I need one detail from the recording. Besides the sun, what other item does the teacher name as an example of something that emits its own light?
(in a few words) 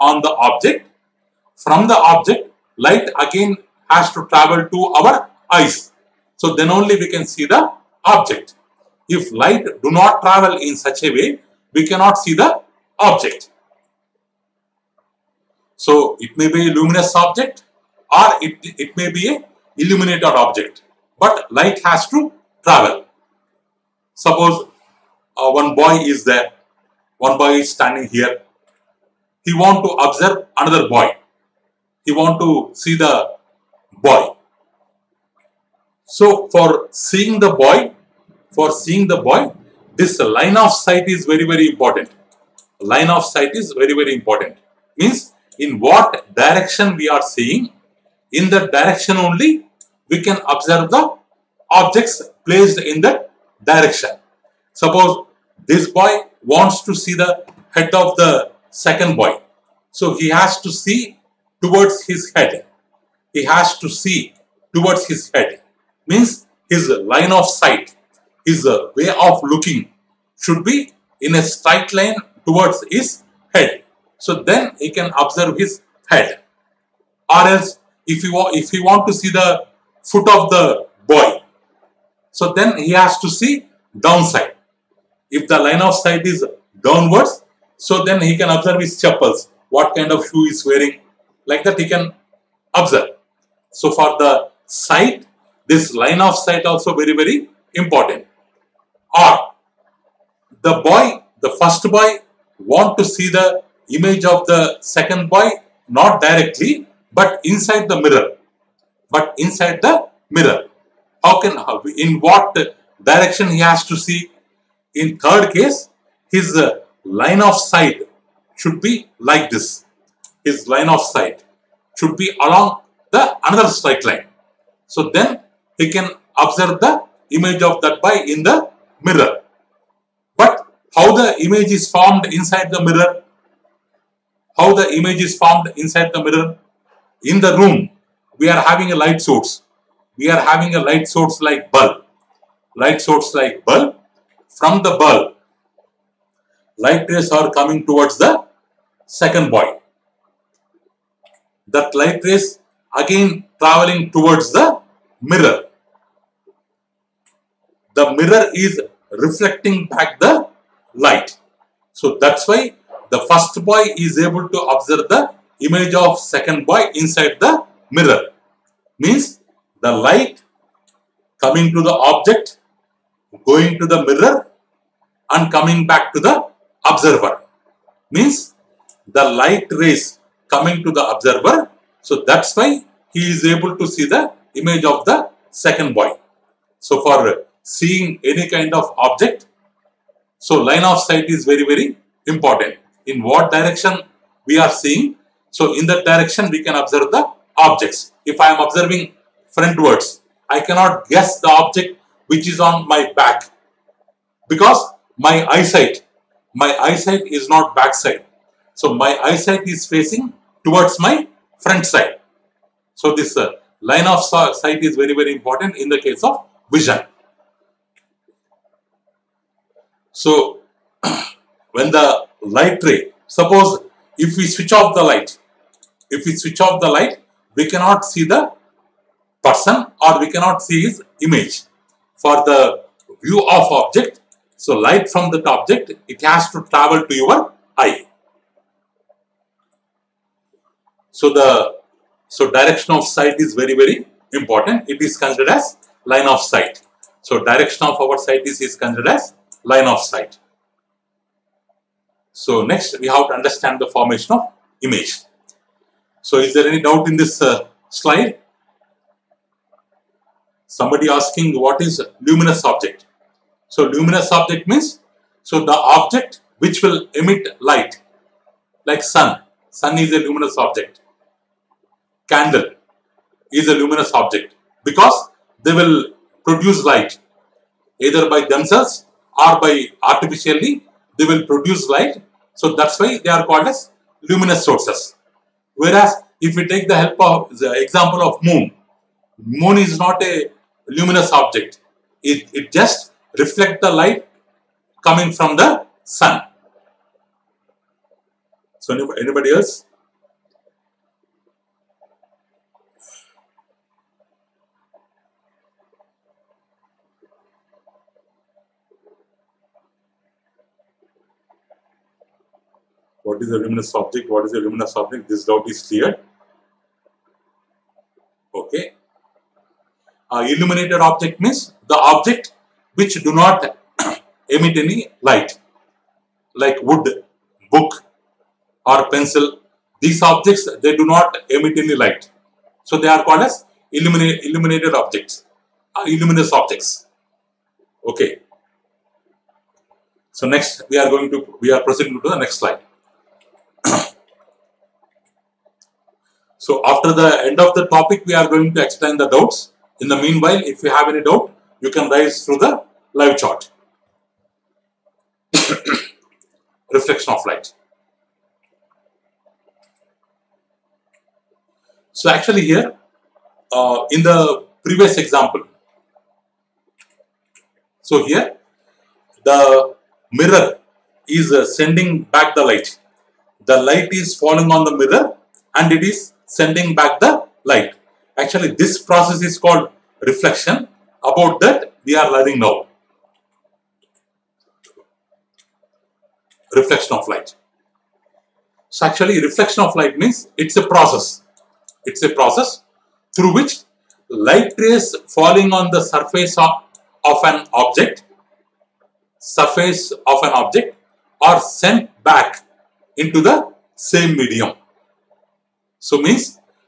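Candle.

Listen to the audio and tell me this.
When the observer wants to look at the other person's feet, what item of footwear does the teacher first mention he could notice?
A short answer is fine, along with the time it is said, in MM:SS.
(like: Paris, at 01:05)
chappals, at 01:28.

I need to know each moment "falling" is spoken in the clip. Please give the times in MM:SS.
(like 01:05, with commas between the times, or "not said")
06:14, 06:35.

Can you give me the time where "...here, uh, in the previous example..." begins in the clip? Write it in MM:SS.
06:02.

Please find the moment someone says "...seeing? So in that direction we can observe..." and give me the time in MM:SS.
03:14.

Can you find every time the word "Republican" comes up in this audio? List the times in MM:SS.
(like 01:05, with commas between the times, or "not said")
not said.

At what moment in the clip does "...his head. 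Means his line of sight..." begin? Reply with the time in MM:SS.
01:05.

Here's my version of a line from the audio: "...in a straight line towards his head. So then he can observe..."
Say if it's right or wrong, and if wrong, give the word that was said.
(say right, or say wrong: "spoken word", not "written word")
right.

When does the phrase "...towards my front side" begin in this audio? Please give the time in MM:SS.
03:30.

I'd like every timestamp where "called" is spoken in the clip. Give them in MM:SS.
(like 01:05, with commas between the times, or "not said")
04:43, 05:33, 06:19.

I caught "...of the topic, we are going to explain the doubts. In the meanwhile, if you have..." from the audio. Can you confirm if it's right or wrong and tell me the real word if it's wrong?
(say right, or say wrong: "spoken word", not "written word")
right.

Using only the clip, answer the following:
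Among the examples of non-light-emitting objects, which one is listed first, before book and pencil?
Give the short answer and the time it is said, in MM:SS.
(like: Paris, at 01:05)
wood, at 05:26.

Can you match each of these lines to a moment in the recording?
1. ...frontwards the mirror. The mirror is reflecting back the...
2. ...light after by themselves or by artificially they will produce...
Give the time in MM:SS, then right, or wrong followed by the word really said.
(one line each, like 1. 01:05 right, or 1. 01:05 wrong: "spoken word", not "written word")
1. 02:34 wrong: "towards", not "frontwards"
2. 04:36 wrong: "either", not "after".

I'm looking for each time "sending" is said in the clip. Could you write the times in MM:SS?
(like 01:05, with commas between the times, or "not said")
06:11, 06:16.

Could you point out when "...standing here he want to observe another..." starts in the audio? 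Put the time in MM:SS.
00:27.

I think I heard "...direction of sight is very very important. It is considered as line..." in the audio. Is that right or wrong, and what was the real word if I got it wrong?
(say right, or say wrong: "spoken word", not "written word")
right.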